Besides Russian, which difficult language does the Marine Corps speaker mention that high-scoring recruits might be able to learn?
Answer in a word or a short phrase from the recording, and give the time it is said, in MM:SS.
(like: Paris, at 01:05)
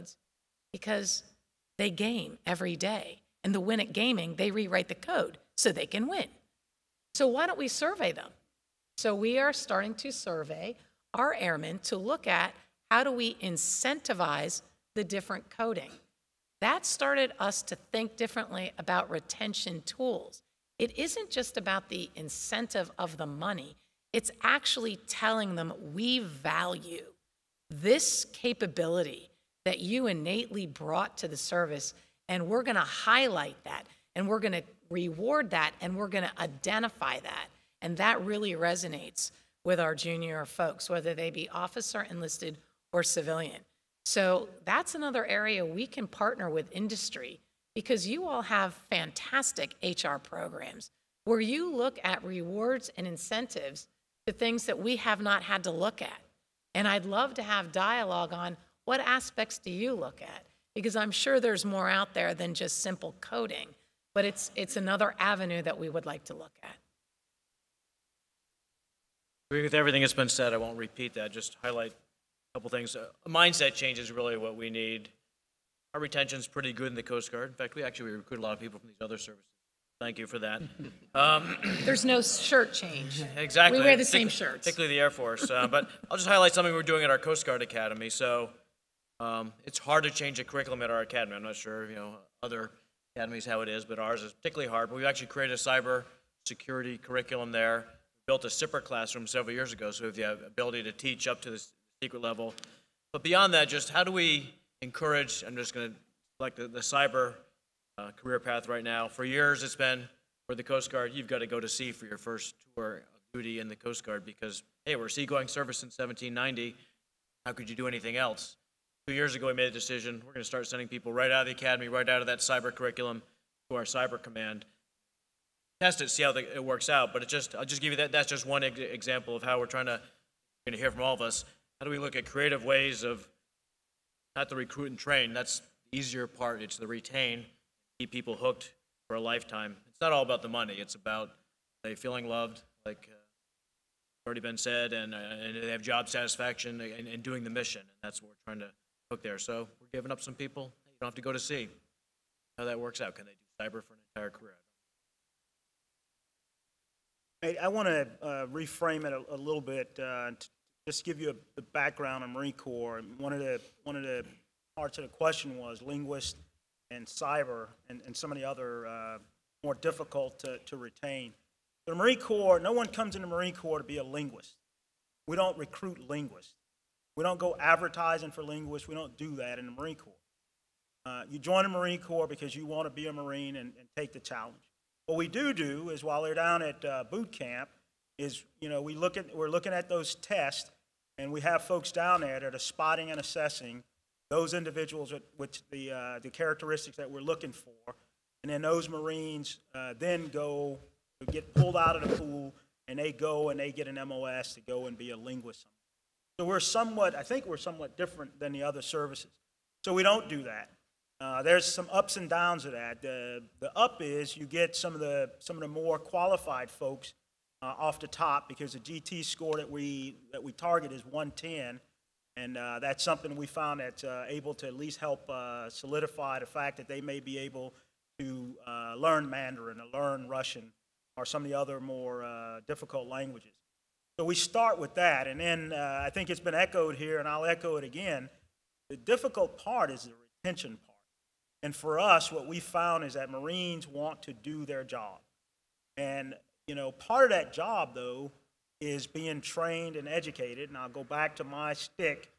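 Mandarin, at 03:49.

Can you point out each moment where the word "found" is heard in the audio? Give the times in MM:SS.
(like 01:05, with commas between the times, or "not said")
03:43, 04:02.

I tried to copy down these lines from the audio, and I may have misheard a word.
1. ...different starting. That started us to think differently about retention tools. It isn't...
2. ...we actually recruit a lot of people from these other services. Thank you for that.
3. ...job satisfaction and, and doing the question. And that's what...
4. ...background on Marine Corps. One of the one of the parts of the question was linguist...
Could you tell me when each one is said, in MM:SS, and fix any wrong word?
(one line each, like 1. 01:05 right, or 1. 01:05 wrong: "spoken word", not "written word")
1. 00:15 wrong: "coding", not "starting"
2. 01:17 right
3. 02:25 wrong: "mission", not "question"
4. 02:41 right.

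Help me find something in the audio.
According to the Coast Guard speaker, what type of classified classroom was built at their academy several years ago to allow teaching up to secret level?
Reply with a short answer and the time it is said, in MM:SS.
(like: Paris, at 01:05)
SIPR classroom, at 01:38.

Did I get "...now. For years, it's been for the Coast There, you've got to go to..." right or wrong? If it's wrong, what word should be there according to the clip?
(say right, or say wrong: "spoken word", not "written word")
wrong: "Guard", not "There".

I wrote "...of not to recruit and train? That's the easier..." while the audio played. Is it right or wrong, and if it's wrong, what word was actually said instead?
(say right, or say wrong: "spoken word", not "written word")
right.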